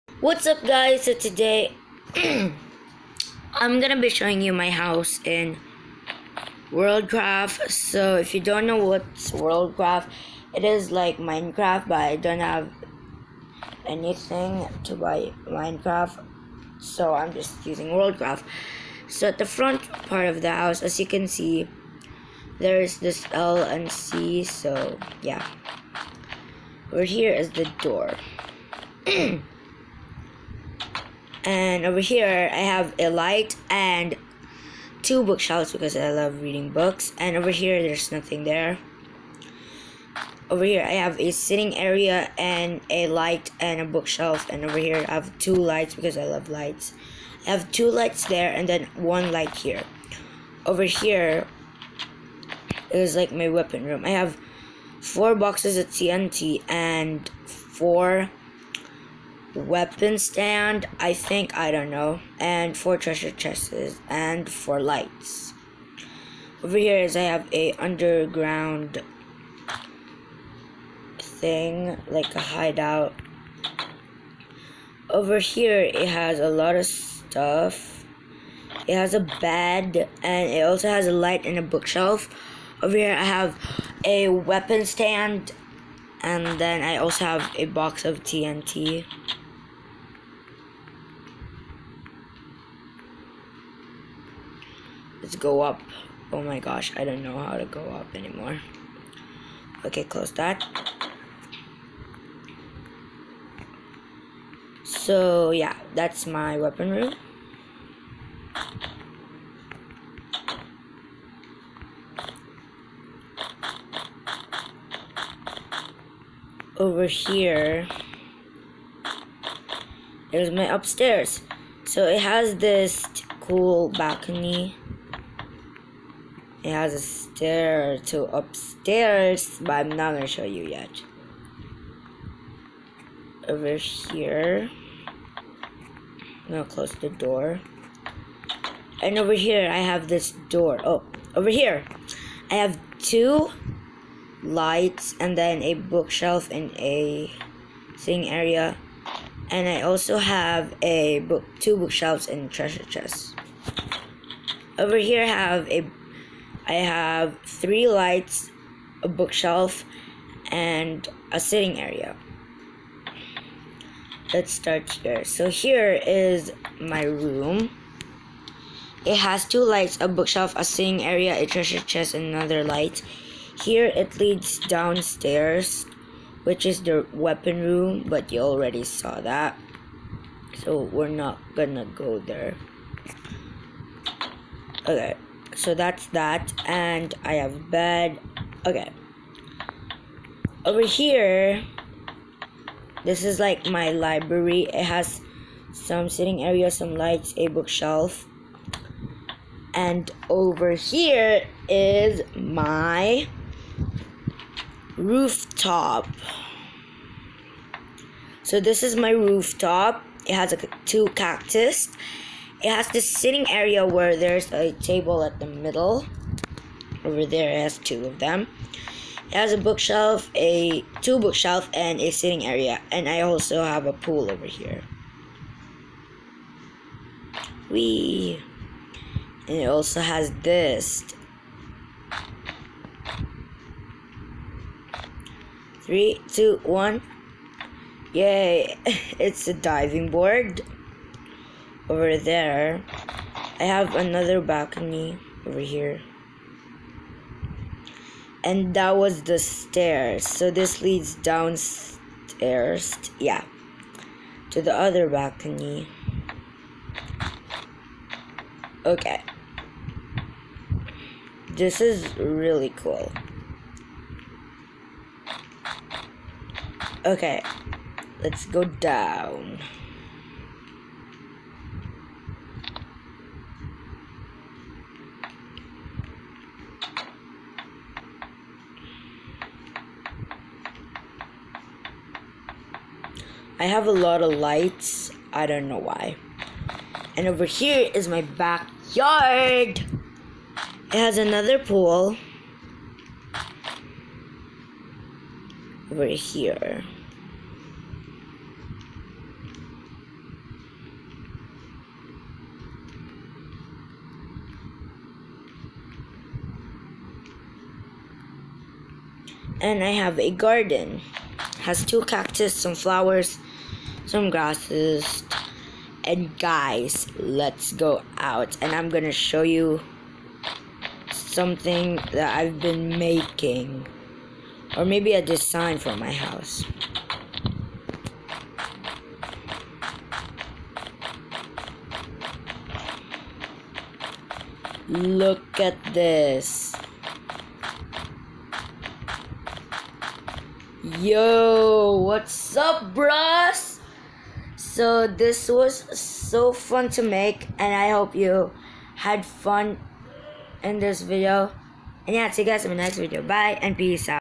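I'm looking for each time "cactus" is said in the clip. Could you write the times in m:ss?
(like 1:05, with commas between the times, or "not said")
3:31, 5:12.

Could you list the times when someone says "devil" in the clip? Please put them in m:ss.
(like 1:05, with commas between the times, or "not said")
not said.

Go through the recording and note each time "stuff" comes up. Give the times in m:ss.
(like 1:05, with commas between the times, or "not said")
1:16.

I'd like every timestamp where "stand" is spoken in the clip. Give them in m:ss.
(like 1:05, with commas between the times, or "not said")
1:00, 1:24.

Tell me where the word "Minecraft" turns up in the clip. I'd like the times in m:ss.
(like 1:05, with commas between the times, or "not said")
0:11, 0:15.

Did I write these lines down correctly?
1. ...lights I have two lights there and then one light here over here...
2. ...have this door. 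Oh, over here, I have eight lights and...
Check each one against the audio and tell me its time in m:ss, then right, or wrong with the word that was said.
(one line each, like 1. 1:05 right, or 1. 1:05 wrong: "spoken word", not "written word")
1. 0:46 right
2. 2:19 wrong: "two", not "eight".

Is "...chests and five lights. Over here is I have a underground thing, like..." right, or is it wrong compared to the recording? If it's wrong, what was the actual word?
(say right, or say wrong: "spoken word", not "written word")
wrong: "four", not "five".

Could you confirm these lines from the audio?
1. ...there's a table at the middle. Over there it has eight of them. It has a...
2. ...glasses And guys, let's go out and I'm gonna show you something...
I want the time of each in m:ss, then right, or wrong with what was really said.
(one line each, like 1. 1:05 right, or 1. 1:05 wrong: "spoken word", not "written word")
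1. 3:34 wrong: "two", not "eight"
2. 5:14 right.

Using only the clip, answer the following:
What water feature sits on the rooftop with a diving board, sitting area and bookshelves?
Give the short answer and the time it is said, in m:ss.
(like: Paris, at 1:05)
A pool, at 3:43.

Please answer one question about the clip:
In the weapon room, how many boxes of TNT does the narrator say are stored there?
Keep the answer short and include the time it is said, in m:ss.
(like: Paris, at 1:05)
4, at 0:54.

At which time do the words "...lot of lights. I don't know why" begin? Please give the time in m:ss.
4:43.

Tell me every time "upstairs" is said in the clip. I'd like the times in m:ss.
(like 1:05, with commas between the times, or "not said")
2:00, 2:08.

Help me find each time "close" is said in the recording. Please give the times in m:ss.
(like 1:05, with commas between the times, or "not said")
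1:40, 2:16.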